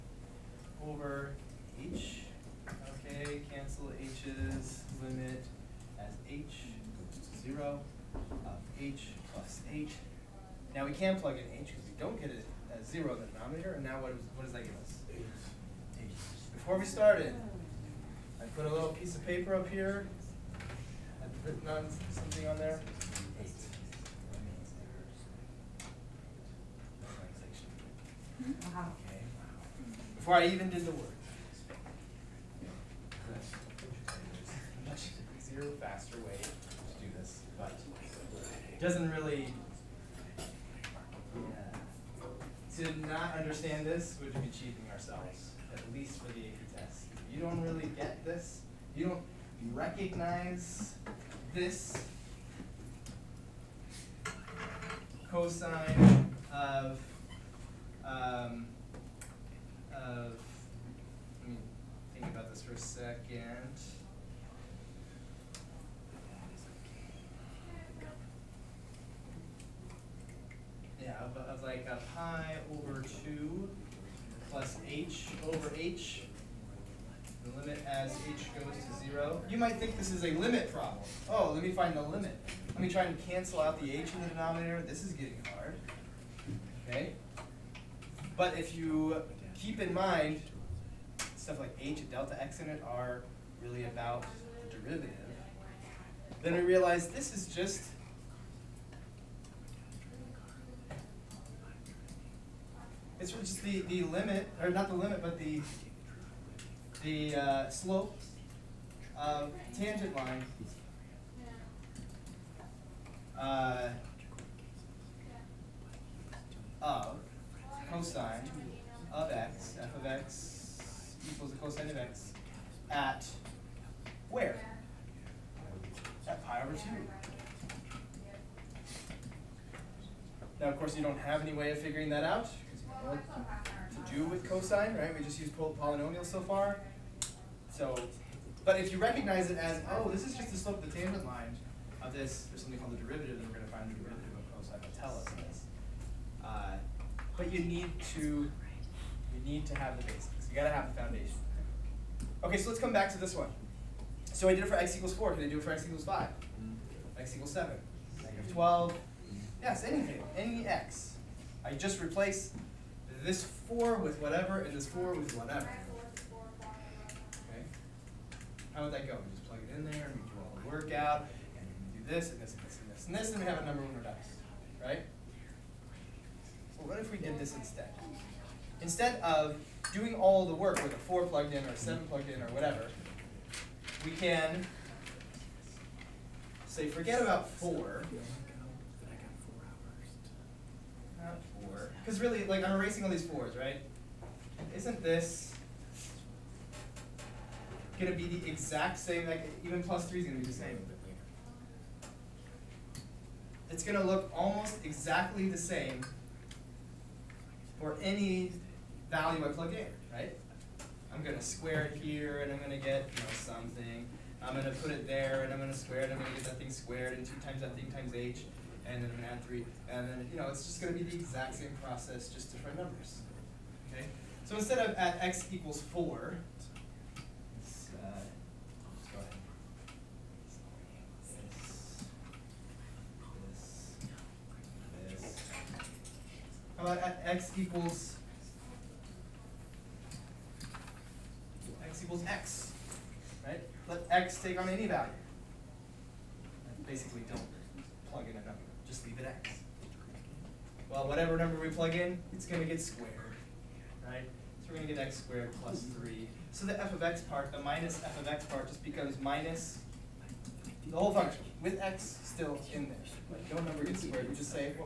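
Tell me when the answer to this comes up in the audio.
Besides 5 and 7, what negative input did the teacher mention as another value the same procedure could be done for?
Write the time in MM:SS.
02:38.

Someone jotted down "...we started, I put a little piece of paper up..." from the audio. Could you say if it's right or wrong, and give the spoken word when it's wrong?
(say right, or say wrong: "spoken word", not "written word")
right.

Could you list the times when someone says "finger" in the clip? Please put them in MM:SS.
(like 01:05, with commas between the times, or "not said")
not said.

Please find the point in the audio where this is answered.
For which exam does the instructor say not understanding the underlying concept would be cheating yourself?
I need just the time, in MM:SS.
00:46.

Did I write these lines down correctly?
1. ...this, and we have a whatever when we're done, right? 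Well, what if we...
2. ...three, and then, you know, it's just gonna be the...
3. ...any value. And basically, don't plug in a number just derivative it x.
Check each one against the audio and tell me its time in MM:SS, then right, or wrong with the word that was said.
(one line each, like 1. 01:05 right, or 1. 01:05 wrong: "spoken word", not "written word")
1. 02:53 wrong: "number", not "whatever"
2. 03:39 right
3. 04:04 wrong: "leave", not "derivative".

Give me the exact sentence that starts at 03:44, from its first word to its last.
So instead of at x equals four, uh, go ahead.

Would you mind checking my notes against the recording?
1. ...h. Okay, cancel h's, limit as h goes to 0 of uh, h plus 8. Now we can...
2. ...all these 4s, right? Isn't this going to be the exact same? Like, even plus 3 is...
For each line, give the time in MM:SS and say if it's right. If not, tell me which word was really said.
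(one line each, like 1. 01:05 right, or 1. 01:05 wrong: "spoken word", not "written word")
1. 00:01 right
2. 03:13 right.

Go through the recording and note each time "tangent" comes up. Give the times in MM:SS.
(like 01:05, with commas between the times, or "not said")
01:49, 02:20.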